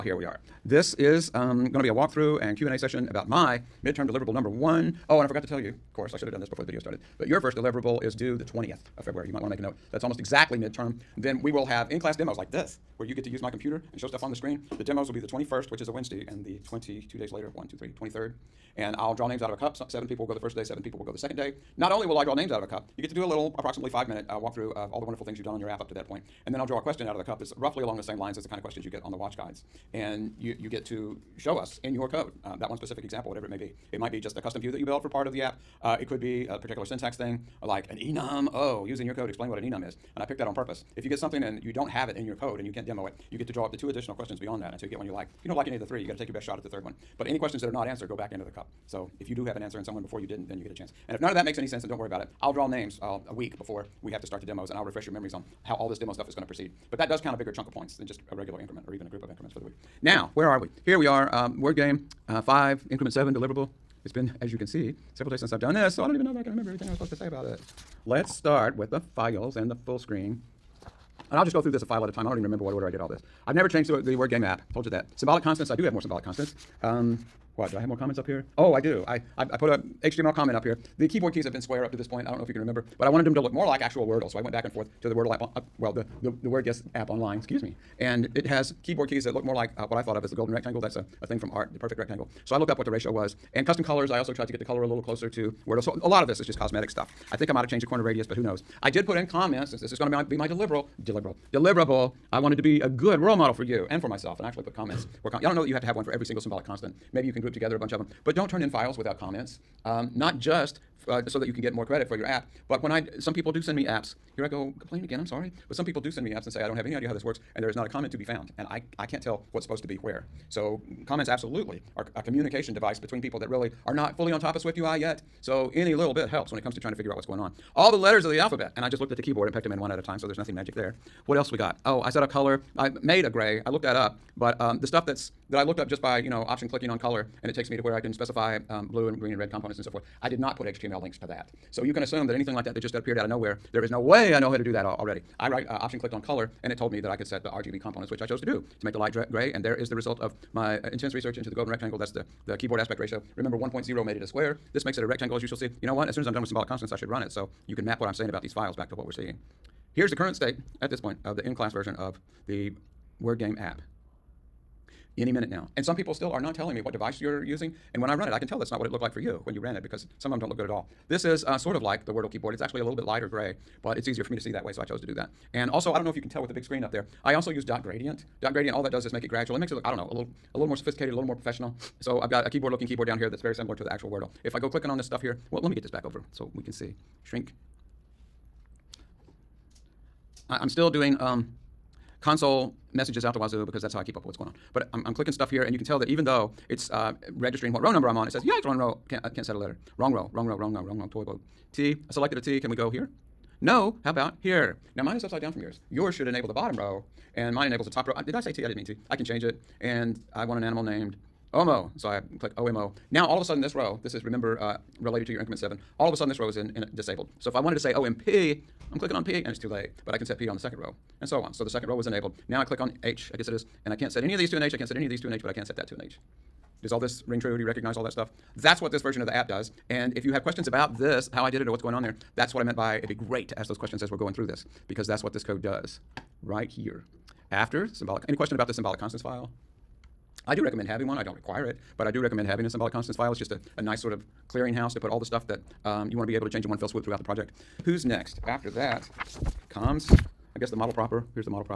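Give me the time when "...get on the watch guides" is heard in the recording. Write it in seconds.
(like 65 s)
28 s.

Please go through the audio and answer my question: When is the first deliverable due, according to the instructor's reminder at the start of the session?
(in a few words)
February 20.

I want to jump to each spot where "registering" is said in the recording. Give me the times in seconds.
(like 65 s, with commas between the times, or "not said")
197 s.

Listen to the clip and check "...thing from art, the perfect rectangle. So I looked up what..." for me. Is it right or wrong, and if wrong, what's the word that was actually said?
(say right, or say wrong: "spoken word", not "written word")
right.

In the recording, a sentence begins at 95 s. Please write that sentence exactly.
So a lot of this is just cosmetic stuff.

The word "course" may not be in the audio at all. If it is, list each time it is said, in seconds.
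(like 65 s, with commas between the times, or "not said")
5 s.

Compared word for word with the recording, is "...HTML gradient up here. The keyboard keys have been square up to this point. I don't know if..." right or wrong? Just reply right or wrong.
wrong.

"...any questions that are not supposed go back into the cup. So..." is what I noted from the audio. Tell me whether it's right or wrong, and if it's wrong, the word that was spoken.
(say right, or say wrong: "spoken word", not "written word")
wrong: "answered", not "supposed".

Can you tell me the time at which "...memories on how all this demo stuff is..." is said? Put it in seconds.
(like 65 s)
55 s.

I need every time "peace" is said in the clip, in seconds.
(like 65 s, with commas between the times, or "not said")
not said.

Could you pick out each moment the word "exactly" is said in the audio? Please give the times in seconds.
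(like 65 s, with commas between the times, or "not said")
10 s.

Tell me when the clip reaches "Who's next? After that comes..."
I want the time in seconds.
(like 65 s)
247 s.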